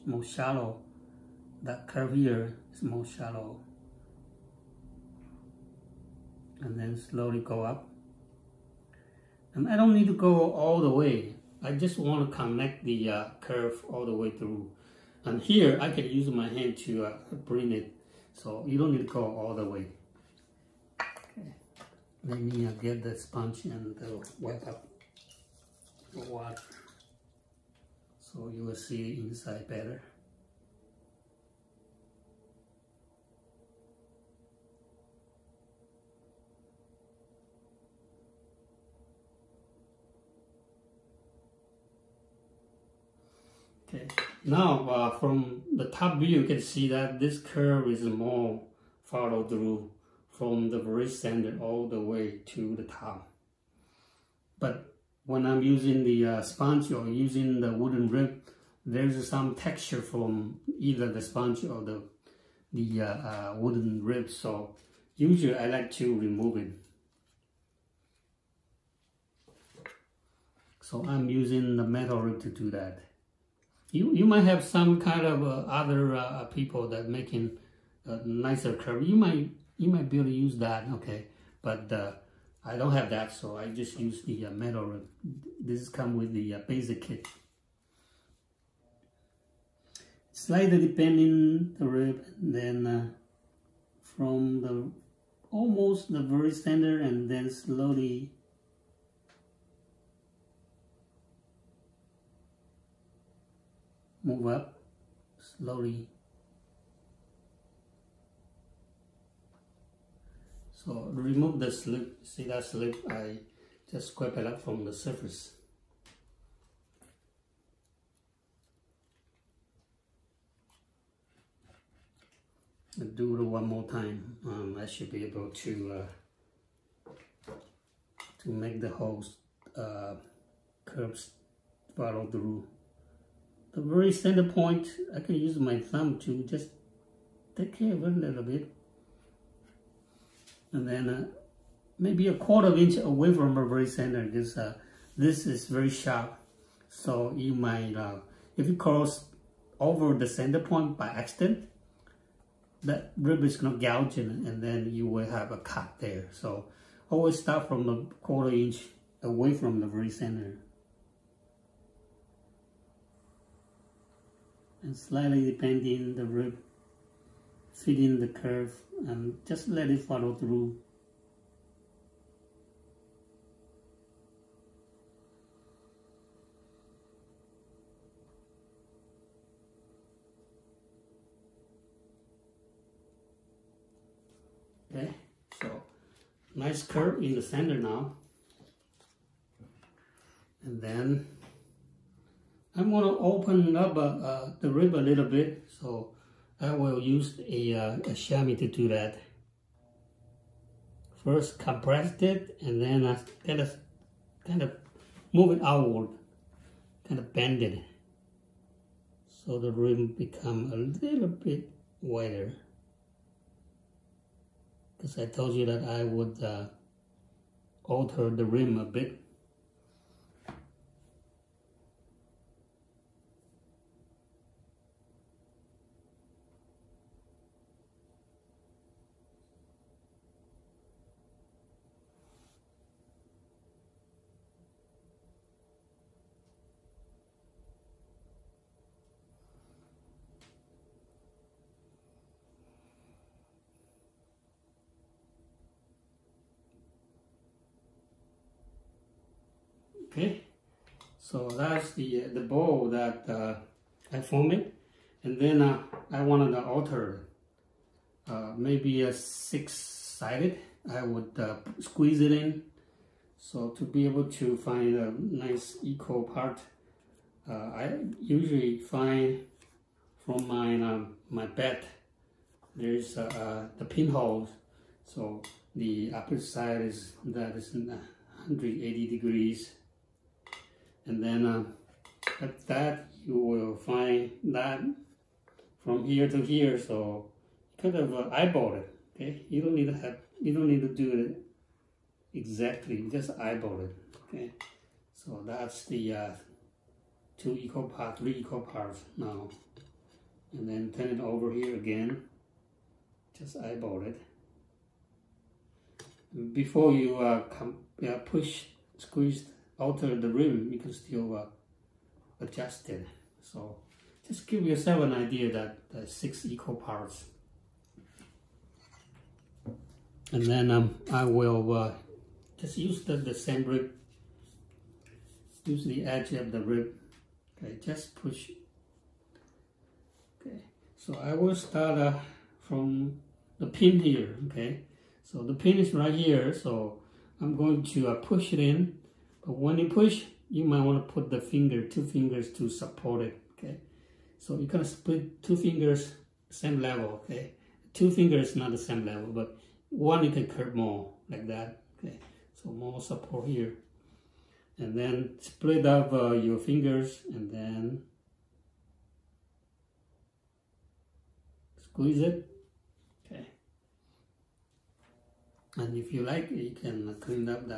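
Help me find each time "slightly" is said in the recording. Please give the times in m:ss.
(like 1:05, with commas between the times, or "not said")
1:30, 2:44.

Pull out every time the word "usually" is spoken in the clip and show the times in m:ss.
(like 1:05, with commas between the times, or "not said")
1:05, 4:28.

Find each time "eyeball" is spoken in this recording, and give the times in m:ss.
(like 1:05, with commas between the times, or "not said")
4:48, 4:53, 5:03.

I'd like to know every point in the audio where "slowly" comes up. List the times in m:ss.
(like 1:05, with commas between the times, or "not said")
0:06, 1:37, 1:45.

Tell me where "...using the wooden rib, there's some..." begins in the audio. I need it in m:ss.
0:57.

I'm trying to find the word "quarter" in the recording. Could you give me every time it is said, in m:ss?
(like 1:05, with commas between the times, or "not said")
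2:22, 2:38.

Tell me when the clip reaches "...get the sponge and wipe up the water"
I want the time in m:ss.
0:22.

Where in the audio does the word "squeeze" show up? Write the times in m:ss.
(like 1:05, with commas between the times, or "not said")
4:21, 5:08, 6:01.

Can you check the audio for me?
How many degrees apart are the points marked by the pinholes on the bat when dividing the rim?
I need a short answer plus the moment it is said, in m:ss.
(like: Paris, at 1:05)
180 degrees, at 4:37.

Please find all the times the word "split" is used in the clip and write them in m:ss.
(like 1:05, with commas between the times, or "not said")
5:44, 5:55.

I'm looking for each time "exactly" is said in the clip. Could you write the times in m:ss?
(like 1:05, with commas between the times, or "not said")
4:52.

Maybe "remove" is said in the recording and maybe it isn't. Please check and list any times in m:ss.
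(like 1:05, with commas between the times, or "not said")
1:06, 1:51.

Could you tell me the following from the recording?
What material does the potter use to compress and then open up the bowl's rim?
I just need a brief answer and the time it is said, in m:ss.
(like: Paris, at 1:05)
a chamois, at 3:18.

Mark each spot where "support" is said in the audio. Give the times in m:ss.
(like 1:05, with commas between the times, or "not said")
5:42, 5:53.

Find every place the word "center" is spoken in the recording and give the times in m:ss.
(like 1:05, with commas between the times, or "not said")
0:51, 1:36, 2:14, 2:23, 2:30, 2:40, 3:07.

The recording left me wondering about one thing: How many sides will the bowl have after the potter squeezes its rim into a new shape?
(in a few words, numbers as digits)
6.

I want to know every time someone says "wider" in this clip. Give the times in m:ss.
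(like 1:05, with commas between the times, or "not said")
3:32.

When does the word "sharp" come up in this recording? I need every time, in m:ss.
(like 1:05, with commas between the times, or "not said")
2:25.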